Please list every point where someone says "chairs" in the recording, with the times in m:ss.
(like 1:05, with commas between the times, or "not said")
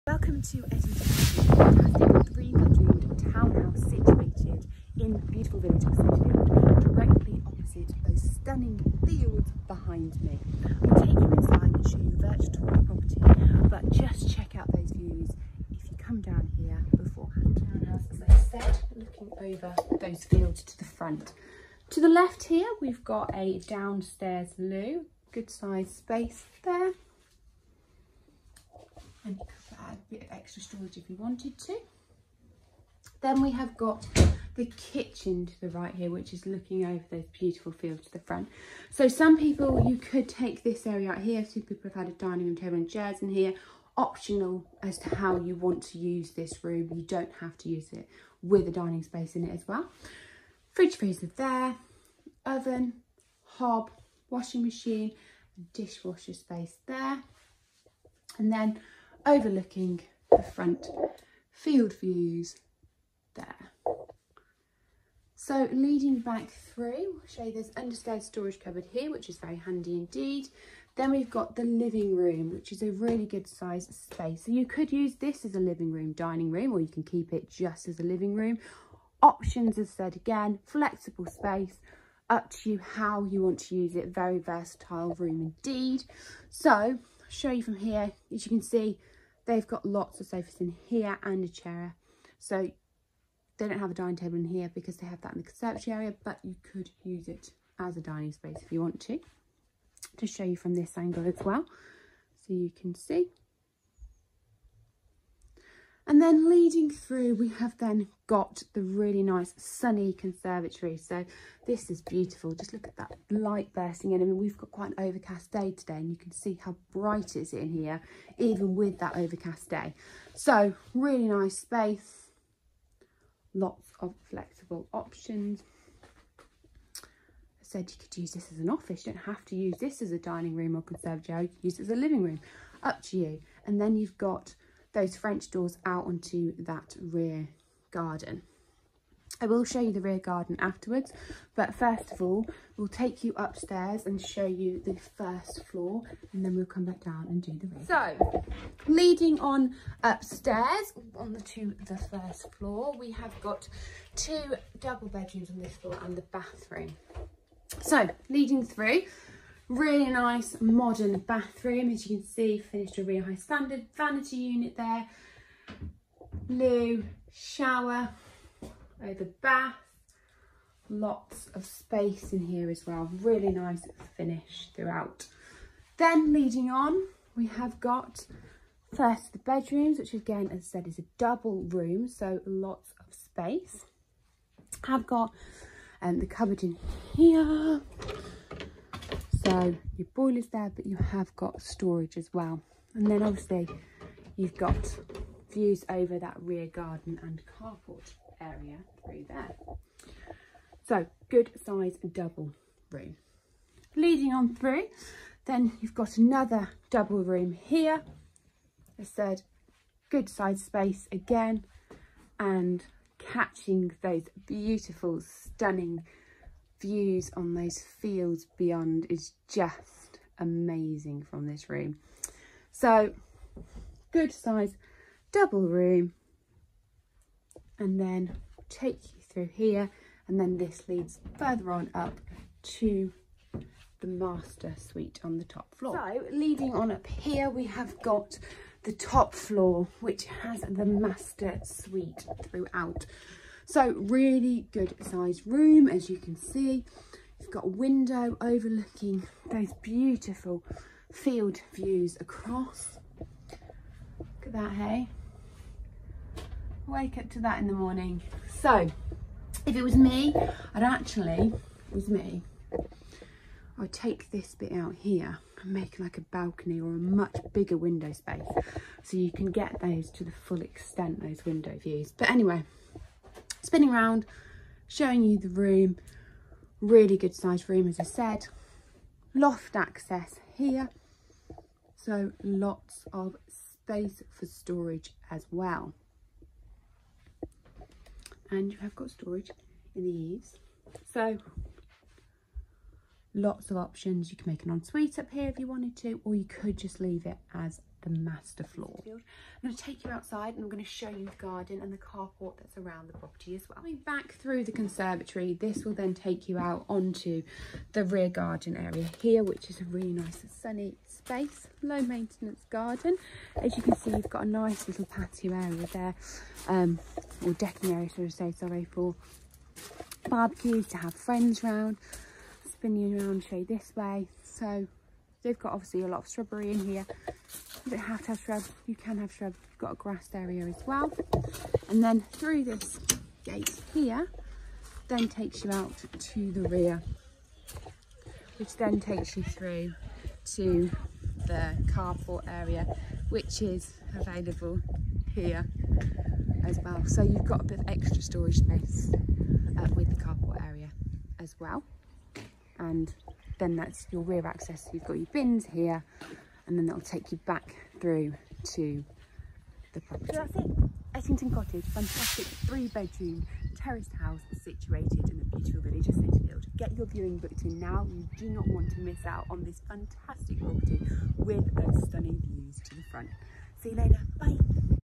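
0:42, 1:31.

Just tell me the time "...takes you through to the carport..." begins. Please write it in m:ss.
5:38.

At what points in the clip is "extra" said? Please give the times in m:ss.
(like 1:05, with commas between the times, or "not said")
0:30, 5:47.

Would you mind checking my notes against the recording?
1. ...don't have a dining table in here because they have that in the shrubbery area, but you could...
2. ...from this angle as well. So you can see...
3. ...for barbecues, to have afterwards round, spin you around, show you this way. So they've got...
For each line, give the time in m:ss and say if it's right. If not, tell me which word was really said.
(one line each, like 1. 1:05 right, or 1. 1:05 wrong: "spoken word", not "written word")
1. 1:33 wrong: "conservatory", not "shrubbery"
2. 1:40 right
3. 5:18 wrong: "friends", not "afterwards".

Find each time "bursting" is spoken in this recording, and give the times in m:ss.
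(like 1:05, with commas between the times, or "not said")
1:53.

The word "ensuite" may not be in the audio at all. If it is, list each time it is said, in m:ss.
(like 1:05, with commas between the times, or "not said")
4:54.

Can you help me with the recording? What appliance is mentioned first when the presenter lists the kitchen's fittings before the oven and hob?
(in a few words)
Fridge freezer.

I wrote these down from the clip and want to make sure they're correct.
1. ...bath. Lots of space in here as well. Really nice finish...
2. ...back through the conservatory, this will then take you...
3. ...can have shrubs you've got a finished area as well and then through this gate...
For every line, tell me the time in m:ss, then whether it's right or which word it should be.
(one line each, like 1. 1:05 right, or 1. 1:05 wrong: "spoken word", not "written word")
1. 2:49 right
2. 5:03 right
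3. 5:28 wrong: "grassed", not "finished".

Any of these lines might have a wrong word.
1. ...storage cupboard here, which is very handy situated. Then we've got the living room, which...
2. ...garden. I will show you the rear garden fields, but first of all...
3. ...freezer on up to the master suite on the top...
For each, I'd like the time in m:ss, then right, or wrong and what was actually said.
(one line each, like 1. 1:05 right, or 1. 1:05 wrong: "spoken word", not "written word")
1. 1:08 wrong: "indeed", not "situated"
2. 2:17 wrong: "afterwards", not "fields"
3. 3:51 wrong: "further", not "freezer".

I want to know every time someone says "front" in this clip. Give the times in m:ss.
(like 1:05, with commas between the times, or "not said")
0:20, 0:38, 1:00, 6:13.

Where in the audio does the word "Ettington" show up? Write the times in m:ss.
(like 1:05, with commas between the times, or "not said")
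0:00, 6:01.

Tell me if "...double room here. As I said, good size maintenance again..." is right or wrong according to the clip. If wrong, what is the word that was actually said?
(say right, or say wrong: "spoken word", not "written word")
wrong: "space", not "maintenance".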